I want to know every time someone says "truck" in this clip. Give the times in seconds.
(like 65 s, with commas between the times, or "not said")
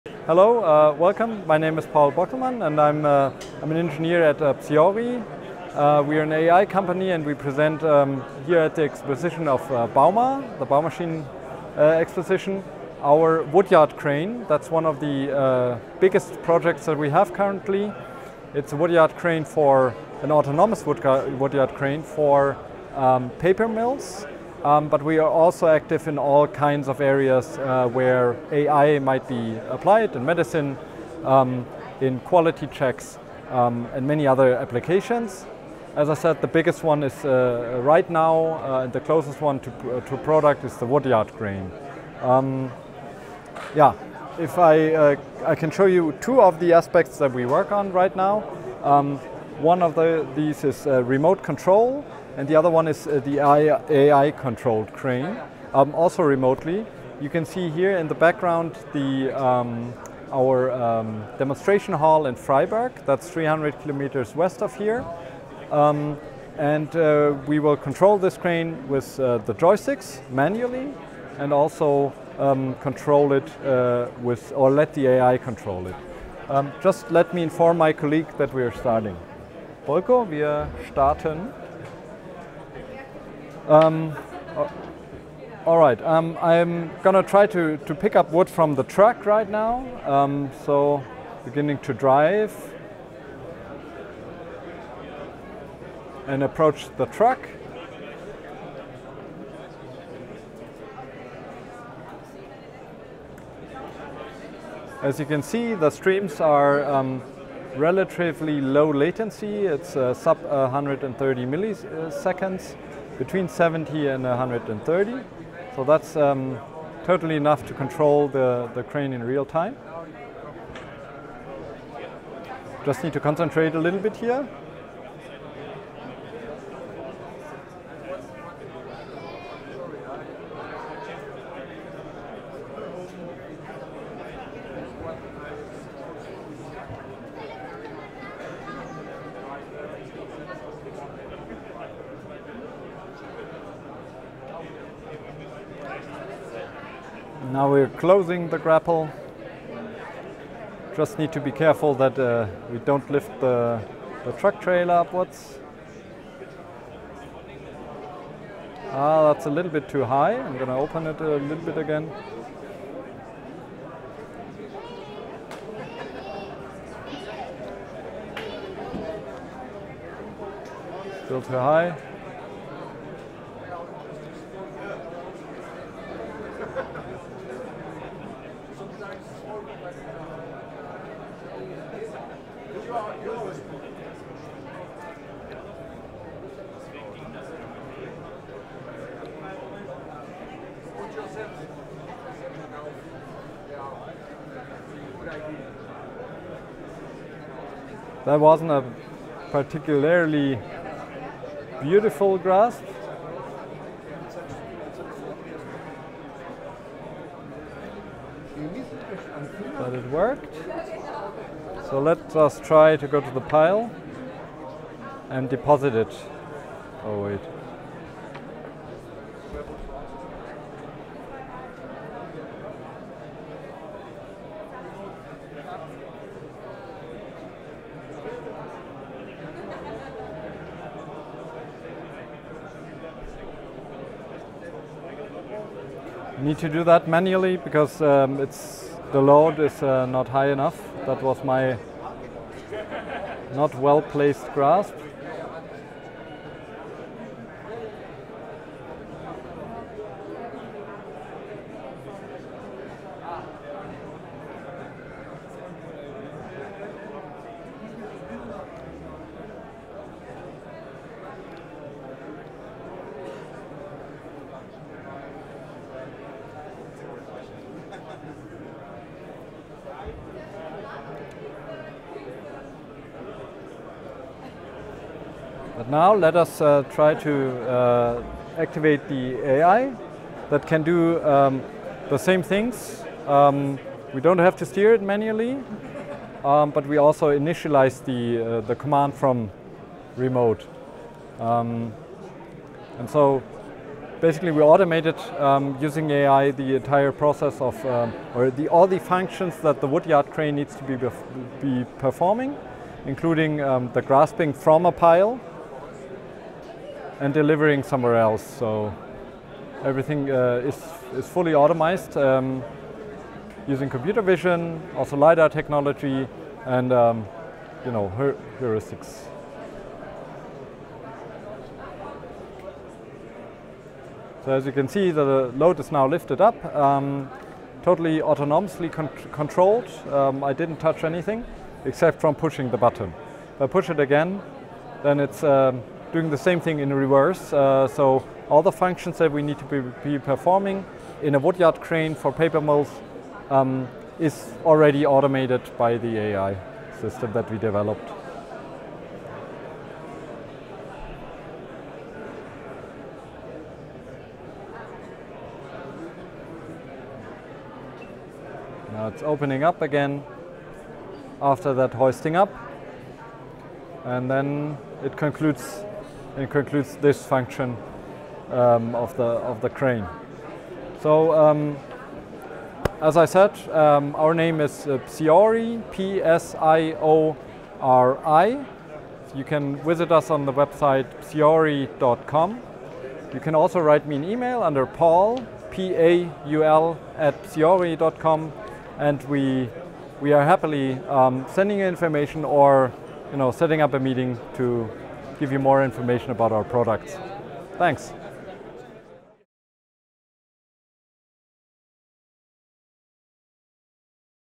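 88 s, 97 s, 154 s.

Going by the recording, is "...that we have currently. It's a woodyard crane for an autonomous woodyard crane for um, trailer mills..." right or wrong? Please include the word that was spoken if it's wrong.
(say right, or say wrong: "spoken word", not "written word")
wrong: "paper", not "trailer".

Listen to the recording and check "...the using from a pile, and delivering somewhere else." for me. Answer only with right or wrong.
wrong.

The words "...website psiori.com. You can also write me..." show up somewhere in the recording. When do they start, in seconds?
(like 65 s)
380 s.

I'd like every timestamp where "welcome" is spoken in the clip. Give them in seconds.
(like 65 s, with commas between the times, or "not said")
0 s.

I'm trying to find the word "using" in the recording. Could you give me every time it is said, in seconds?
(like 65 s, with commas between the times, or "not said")
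295 s, 313 s.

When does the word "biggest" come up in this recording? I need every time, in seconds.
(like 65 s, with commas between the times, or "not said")
15 s, 36 s.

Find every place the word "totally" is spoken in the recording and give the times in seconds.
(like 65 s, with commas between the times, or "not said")
117 s, 327 s.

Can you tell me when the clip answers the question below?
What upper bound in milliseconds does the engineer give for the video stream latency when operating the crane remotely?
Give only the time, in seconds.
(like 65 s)
110 s.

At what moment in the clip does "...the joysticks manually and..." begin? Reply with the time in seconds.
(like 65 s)
69 s.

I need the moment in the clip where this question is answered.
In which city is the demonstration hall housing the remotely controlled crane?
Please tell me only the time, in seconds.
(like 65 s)
62 s.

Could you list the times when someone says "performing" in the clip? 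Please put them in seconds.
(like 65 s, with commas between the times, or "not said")
301 s, 340 s.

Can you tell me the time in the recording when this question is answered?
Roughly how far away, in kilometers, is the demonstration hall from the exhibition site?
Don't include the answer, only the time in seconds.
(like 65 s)
63 s.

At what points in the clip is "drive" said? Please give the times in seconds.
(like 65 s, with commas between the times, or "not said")
91 s.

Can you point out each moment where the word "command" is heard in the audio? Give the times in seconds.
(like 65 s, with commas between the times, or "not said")
288 s.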